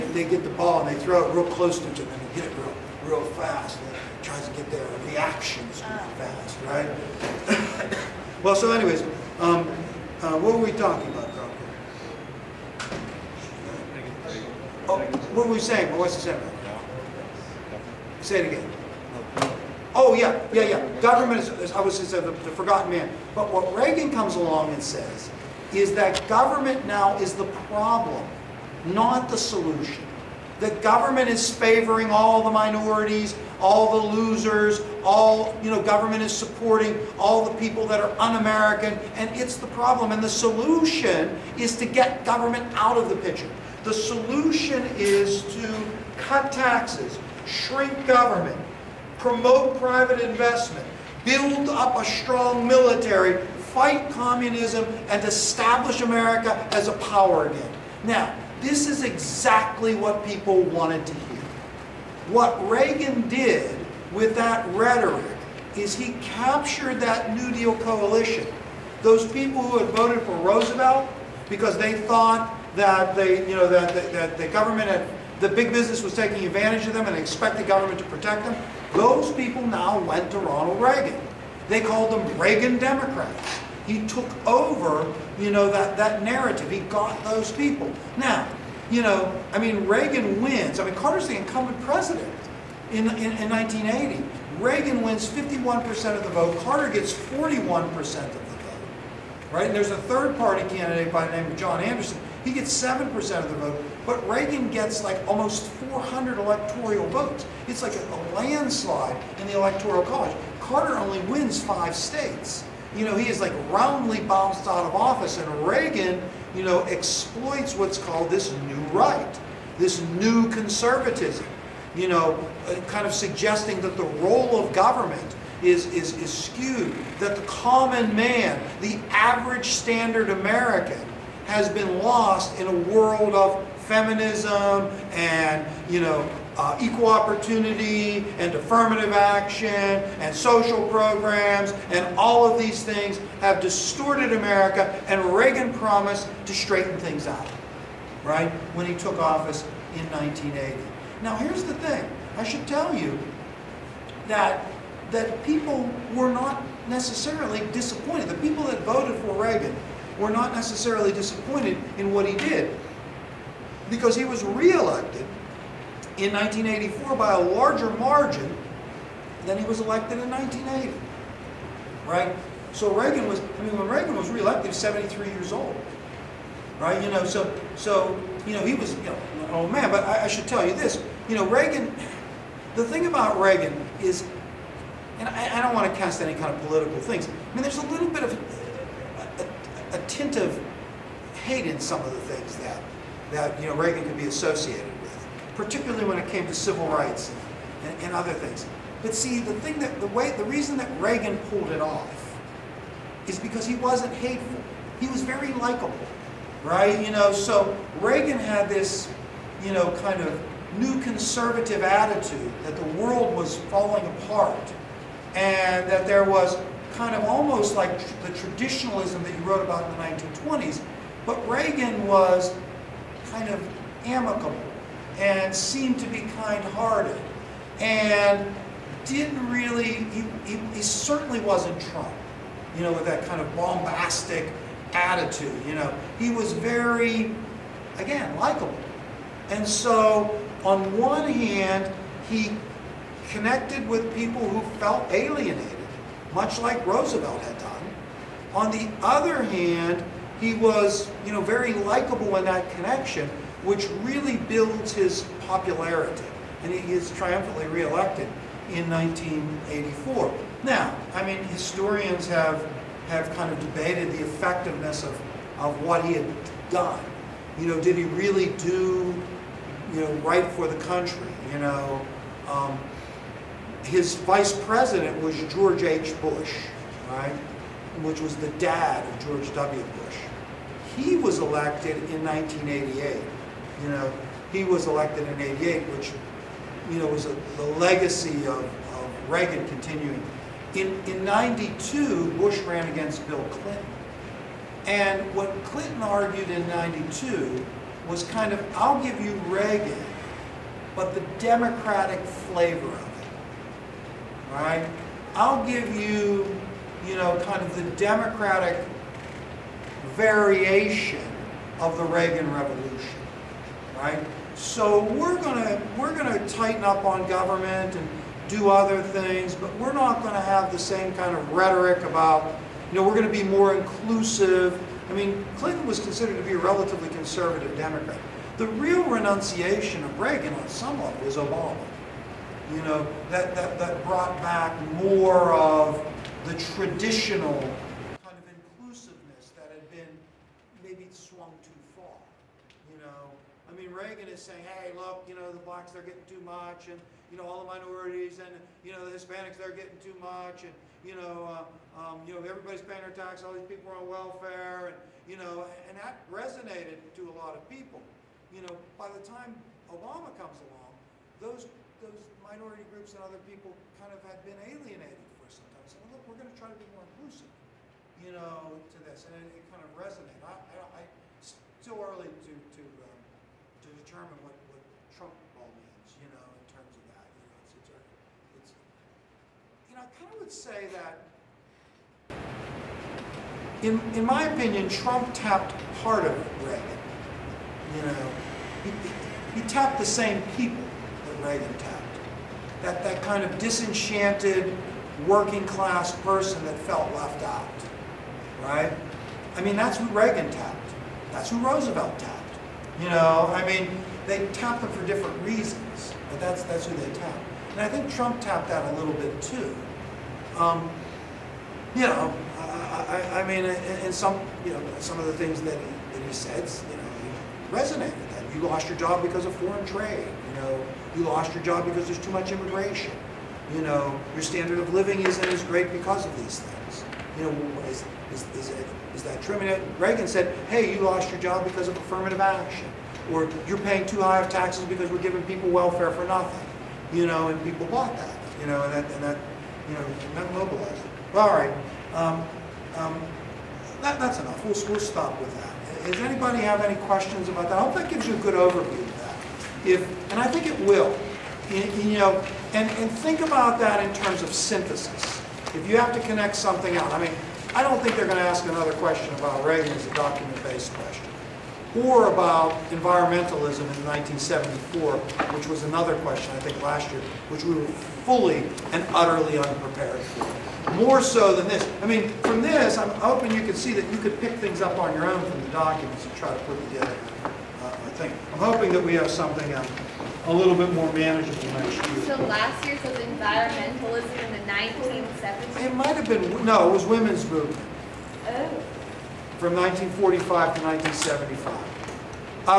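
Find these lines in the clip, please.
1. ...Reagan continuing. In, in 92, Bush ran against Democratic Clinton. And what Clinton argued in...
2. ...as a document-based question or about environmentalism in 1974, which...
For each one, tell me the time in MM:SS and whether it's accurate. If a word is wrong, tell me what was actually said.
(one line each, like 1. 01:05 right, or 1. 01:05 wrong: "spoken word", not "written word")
1. 04:49 wrong: "Bill", not "Democratic"
2. 07:39 right.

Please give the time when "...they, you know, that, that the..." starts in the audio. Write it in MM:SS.
01:13.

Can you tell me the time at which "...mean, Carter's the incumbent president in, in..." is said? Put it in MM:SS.
01:30.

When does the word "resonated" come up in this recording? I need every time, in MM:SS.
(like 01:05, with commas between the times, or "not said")
05:56, 06:09, 06:57.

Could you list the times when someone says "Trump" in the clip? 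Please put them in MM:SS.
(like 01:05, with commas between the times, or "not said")
03:51, 06:15, 06:24, 06:48.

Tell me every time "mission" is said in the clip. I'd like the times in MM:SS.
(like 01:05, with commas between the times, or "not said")
not said.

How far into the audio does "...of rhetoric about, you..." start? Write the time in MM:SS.
05:21.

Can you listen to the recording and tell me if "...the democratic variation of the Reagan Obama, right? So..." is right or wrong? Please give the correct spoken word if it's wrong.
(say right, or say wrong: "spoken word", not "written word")
wrong: "Revolution", not "Obama".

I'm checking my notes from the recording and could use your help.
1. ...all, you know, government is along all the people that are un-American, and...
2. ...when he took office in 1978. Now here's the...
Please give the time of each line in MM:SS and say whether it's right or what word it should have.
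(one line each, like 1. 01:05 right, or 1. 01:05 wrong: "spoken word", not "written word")
1. 00:35 wrong: "supporting", not "along"
2. 02:28 wrong: "1980", not "1978".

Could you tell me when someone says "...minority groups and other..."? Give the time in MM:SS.
06:02.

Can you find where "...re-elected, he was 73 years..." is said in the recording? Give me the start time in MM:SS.
02:54.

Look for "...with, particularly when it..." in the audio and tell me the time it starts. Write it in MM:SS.
03:15.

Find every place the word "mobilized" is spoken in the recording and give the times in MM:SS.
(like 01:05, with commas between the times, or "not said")
07:20.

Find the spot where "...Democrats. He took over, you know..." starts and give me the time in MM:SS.
01:22.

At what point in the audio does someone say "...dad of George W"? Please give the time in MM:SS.
04:38.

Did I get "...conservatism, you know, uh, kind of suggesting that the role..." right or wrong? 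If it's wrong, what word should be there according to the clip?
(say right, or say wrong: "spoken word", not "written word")
right.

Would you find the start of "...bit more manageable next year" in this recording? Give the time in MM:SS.
08:00.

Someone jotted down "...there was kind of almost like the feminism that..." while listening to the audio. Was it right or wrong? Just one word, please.
wrong.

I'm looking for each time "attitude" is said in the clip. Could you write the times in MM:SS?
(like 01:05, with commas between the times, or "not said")
03:31, 03:54.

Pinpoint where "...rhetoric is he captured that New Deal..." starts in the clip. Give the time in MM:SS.
01:04.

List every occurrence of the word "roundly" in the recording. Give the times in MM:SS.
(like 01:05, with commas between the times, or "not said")
01:53.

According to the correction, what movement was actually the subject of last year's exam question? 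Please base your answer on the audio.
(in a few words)
women's movement.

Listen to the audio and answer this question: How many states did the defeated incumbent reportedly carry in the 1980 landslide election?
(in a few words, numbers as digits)
5.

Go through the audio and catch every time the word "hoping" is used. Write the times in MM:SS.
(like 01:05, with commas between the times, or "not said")
07:53, 07:58.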